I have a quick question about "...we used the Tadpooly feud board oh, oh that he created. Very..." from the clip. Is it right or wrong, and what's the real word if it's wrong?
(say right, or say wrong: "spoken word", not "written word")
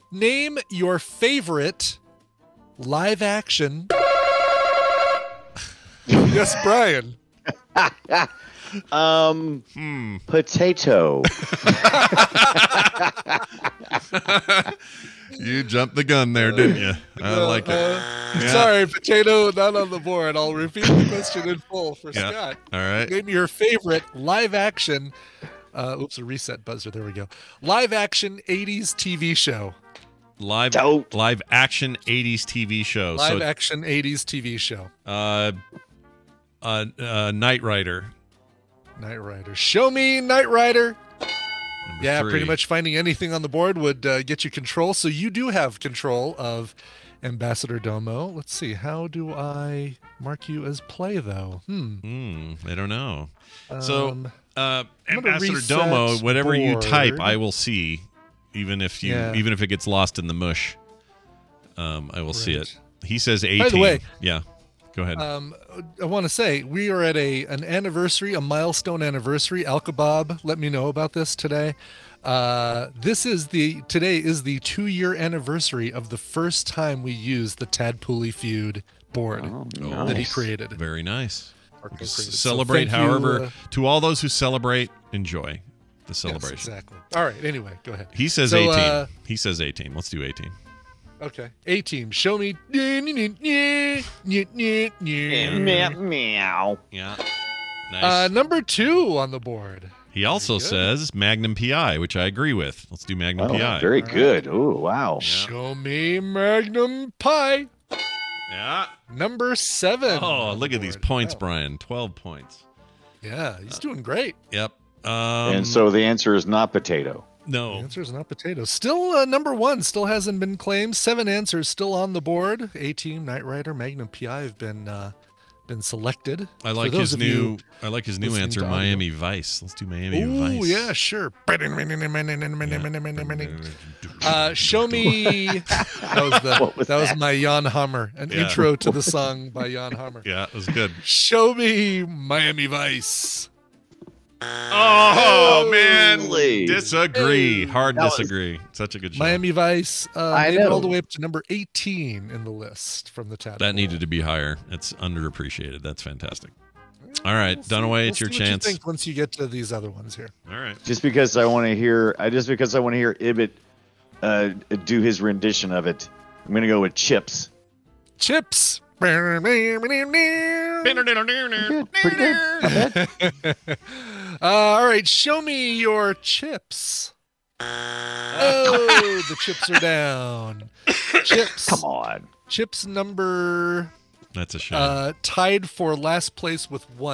right.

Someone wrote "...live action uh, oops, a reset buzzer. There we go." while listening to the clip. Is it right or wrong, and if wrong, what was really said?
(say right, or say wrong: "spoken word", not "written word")
right.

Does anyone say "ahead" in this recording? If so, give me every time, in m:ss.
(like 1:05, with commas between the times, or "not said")
1:05, 1:27.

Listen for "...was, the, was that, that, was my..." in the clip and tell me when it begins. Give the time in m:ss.
2:16.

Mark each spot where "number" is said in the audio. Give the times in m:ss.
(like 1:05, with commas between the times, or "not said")
0:41, 1:38, 1:49, 1:59, 2:31, 3:02.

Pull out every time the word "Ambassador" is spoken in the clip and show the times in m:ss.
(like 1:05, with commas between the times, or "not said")
0:47, 0:55.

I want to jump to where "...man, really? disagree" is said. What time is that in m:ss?
2:25.